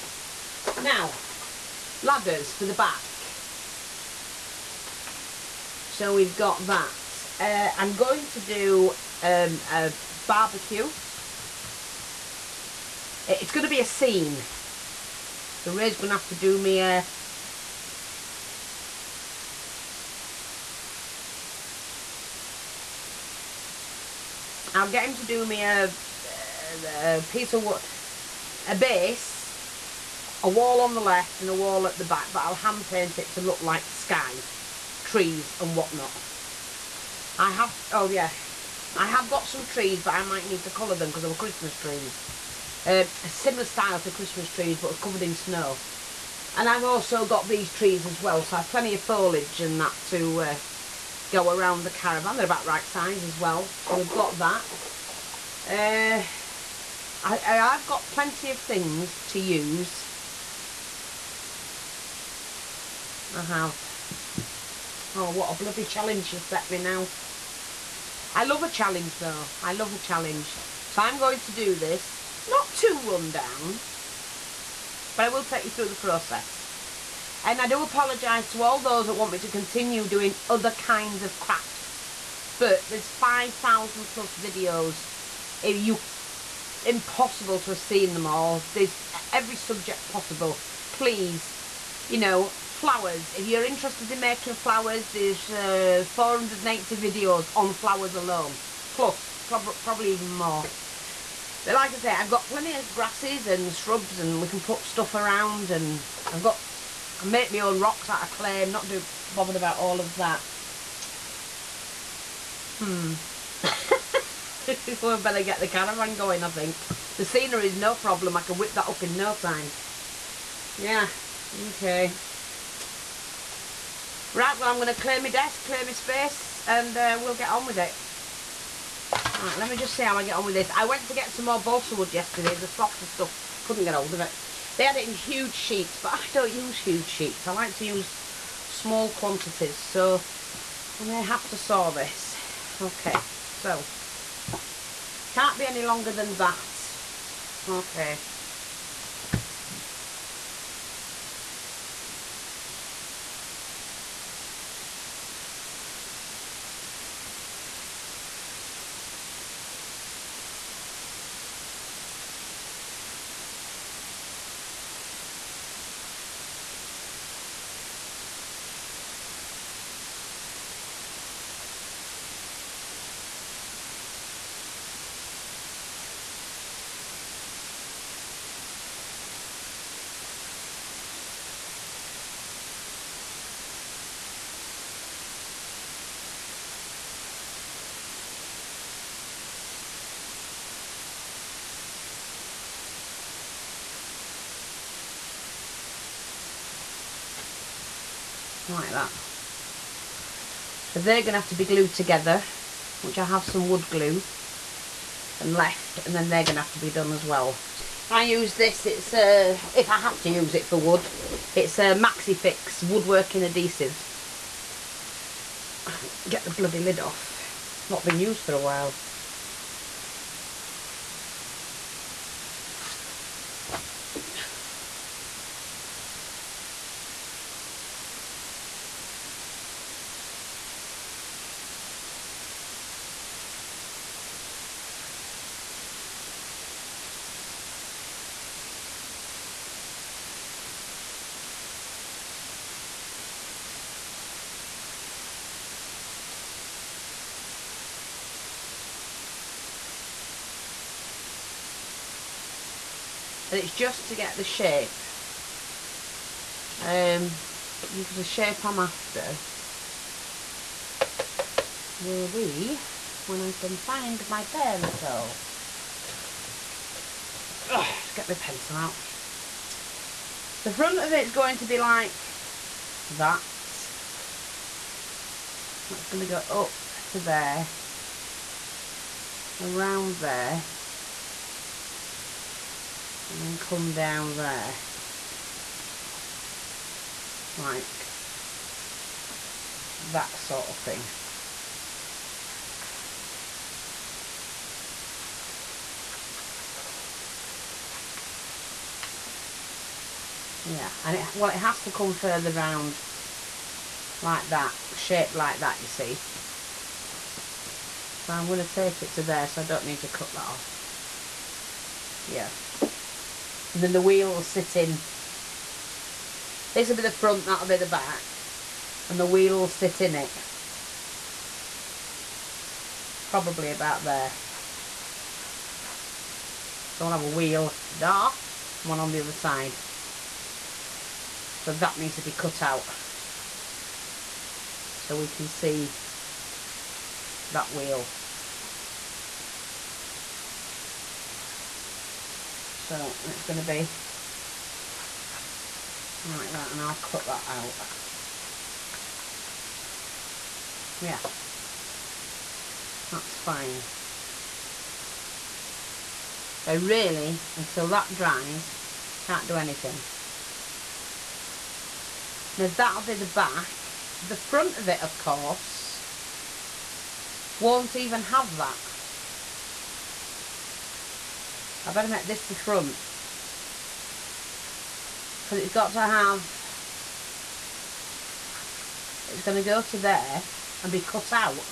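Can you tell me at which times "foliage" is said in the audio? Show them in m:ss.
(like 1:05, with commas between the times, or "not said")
0:48.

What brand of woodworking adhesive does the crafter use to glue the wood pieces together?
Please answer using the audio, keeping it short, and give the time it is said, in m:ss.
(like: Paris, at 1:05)
MaxiFix, at 3:31.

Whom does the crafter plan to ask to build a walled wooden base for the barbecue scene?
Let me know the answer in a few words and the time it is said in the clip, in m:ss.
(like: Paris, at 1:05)
Ray, at 0:15.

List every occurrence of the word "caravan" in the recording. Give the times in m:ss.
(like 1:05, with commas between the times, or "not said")
0:51, 1:55.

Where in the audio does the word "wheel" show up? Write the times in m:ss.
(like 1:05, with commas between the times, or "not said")
5:13, 5:19, 5:27, 5:37.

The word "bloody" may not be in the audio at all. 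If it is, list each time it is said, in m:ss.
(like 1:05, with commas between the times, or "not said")
1:05, 3:36.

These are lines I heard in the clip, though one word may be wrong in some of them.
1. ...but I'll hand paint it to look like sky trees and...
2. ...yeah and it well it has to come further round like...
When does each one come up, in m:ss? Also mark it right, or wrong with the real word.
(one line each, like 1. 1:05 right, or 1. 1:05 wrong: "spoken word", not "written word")
1. 0:32 right
2. 5:00 right.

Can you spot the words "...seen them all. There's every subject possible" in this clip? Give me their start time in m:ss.
1:27.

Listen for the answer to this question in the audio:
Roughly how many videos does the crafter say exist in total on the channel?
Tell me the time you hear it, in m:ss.
1:23.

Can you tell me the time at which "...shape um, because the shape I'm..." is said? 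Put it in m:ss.
4:14.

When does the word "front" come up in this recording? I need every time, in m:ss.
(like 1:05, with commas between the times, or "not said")
4:30, 5:17, 6:04, 6:12.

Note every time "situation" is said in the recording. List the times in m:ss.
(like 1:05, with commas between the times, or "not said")
not said.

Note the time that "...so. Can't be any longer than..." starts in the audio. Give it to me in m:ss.
2:23.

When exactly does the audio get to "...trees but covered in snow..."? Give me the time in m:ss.
0:44.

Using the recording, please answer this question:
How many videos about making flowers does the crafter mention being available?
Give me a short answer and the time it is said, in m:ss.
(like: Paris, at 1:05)
480, at 1:36.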